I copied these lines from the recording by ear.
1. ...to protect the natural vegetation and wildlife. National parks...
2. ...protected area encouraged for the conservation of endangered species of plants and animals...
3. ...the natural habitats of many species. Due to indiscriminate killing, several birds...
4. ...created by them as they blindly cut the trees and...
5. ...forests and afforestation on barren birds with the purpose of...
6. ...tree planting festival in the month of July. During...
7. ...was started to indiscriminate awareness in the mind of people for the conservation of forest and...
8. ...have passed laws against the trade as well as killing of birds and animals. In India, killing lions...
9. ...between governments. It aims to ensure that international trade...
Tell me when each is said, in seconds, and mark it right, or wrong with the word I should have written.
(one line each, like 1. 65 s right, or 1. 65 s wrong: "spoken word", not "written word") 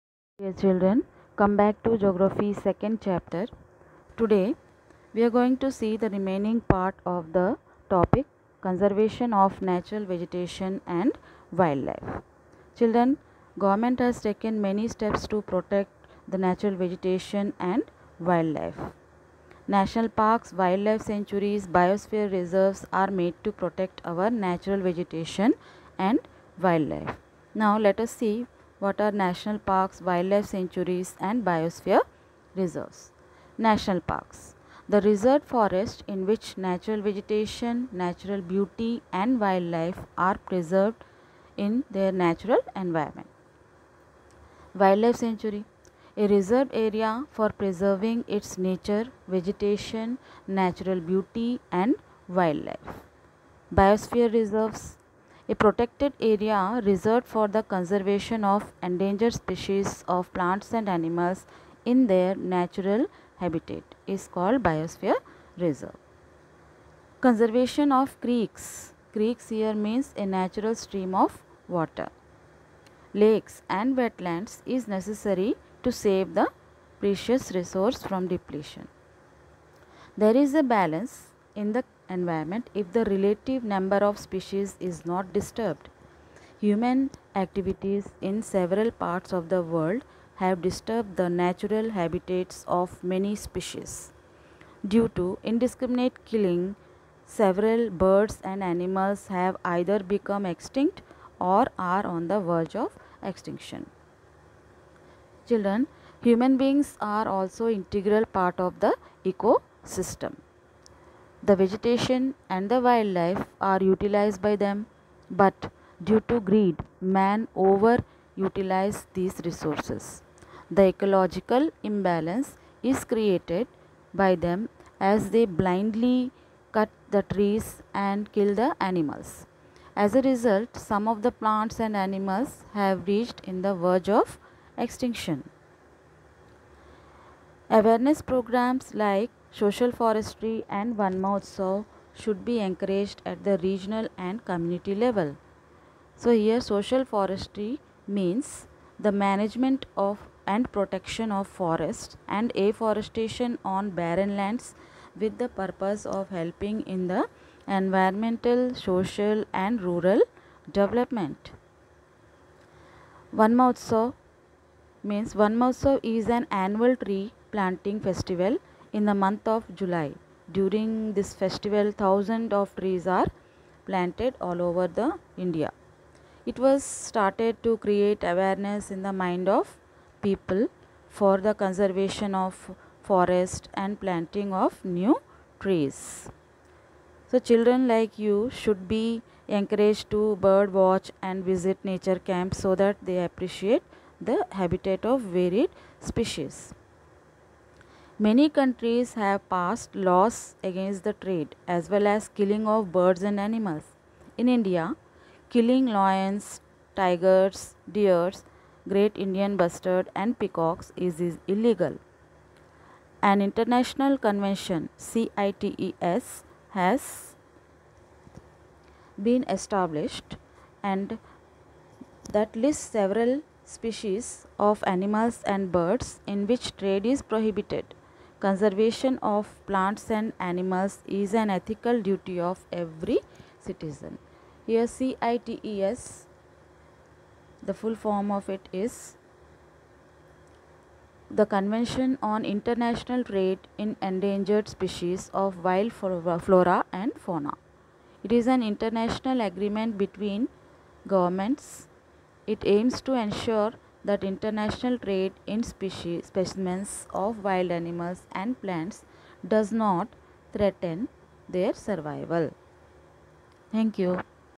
1. 15 s right
2. 55 s wrong: "reserved", not "encouraged"
3. 91 s right
4. 123 s right
5. 151 s wrong: "lands", not "birds"
6. 166 s right
7. 176 s wrong: "create", not "indiscriminate"
8. 199 s right
9. 249 s right.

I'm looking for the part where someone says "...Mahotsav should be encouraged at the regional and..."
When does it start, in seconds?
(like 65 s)
141 s.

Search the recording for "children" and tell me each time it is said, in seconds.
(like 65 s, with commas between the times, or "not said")
0 s, 12 s, 105 s, 187 s.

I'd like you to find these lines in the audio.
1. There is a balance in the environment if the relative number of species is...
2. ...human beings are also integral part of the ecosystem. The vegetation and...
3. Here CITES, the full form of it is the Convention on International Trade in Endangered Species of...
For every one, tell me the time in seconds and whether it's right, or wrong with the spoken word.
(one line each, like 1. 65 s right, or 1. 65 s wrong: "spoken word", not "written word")
1. 80 s right
2. 106 s right
3. 234 s right.